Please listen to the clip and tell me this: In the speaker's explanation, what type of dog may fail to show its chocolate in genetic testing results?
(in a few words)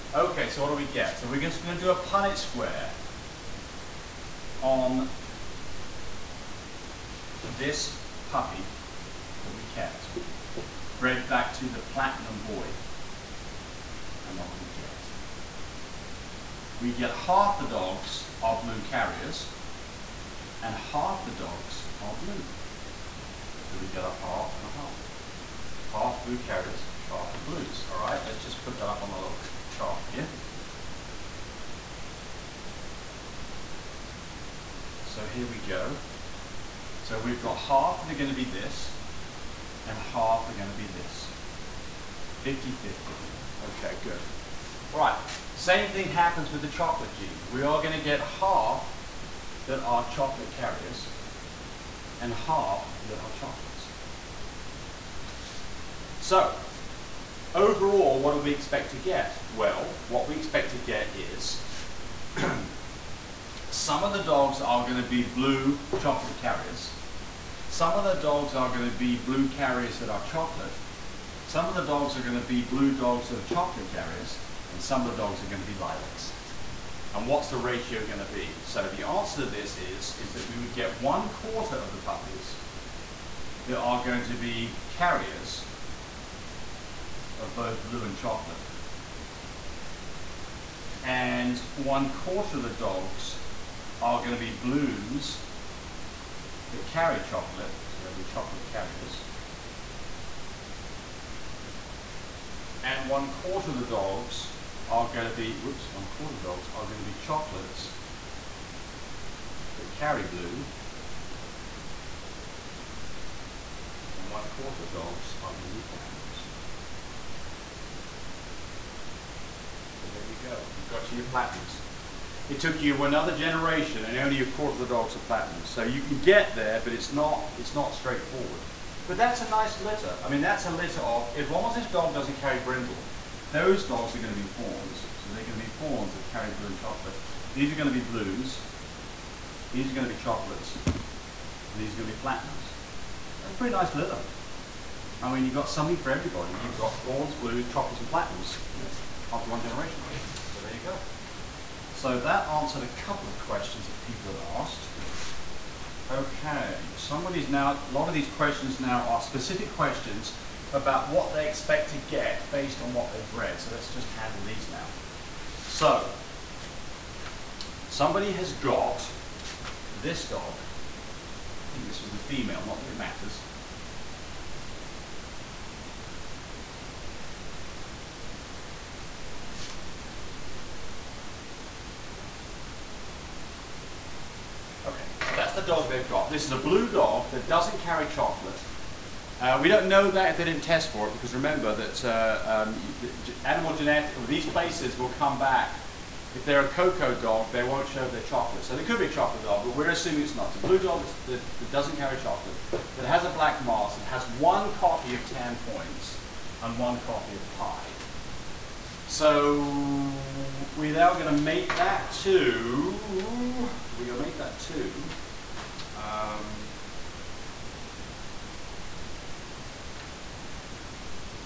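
Cocoa dog.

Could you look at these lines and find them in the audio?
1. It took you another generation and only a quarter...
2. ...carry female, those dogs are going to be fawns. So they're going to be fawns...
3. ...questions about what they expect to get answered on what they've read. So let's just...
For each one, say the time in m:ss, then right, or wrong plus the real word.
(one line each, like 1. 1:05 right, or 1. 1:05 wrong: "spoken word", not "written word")
1. 2:02 right
2. 2:12 wrong: "brindle", not "female"
3. 2:39 wrong: "based", not "answered".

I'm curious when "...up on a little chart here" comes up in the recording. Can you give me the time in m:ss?
0:28.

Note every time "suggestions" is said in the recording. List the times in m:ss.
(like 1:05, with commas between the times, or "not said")
not said.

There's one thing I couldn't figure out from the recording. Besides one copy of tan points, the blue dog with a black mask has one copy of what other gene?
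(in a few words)
Pie.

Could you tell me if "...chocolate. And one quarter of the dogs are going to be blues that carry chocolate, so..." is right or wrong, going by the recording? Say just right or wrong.
right.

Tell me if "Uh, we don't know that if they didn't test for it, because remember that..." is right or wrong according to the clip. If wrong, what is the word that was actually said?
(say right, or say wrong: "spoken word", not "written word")
right.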